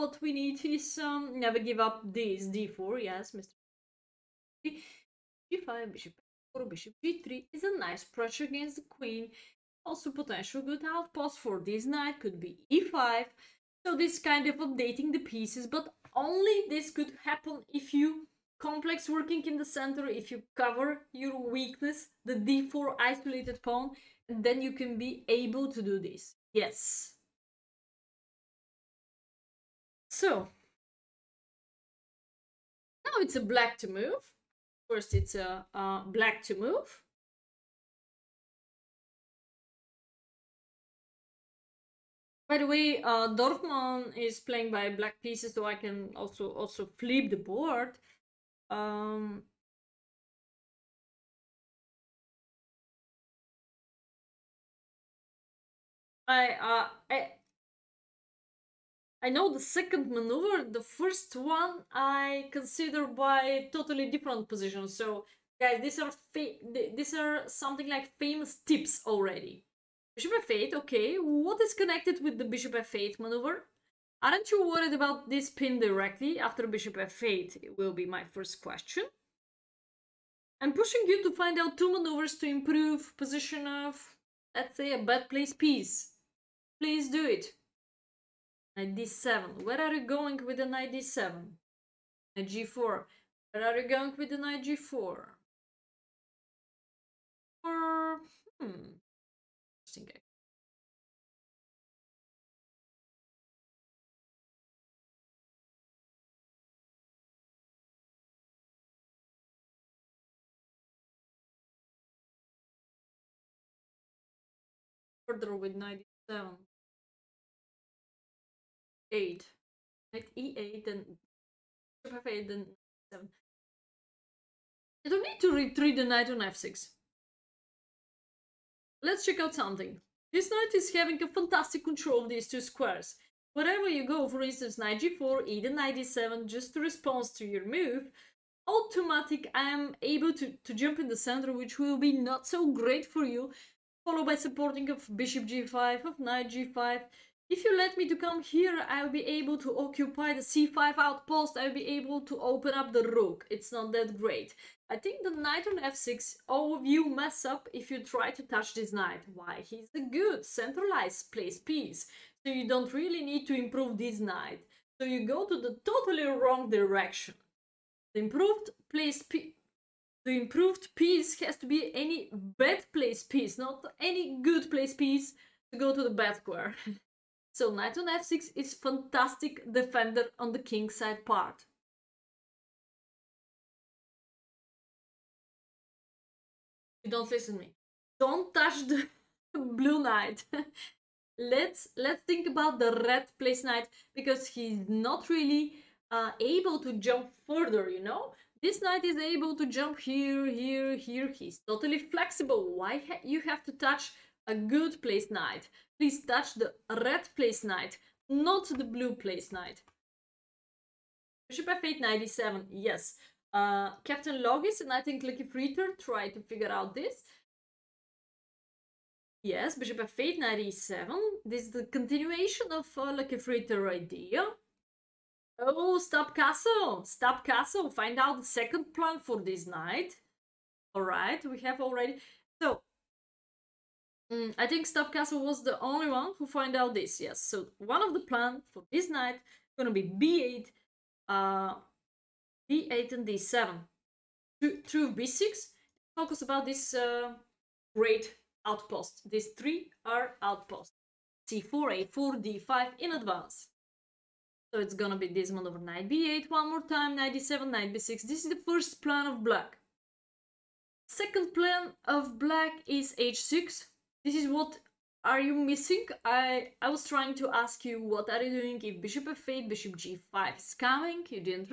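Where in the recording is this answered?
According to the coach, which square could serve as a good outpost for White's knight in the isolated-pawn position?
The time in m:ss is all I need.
0:12.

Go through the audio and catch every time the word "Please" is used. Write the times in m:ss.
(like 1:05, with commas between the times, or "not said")
1:26, 3:25.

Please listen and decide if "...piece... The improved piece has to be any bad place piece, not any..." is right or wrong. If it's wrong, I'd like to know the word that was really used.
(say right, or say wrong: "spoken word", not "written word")
right.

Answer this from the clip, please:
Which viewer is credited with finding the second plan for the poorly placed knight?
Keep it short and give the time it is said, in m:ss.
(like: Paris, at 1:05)
Stopcastle, at 3:54.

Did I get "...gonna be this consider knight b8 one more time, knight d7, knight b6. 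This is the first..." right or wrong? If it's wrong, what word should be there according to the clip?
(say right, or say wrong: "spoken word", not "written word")
wrong: "maneuver", not "consider".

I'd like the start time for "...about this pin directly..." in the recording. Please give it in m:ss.
1:14.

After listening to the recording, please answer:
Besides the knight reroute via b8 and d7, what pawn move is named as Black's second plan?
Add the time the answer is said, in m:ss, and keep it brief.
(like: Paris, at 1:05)
h6, at 4:23.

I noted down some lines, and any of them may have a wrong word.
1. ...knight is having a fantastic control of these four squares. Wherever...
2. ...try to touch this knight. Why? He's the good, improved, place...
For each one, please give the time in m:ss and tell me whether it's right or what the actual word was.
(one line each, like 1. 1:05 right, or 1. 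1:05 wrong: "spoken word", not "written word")
1. 2:10 wrong: "two", not "four"
2. 2:38 wrong: "centralized", not "improved".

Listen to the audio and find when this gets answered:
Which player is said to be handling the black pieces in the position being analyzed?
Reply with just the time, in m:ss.
0:43.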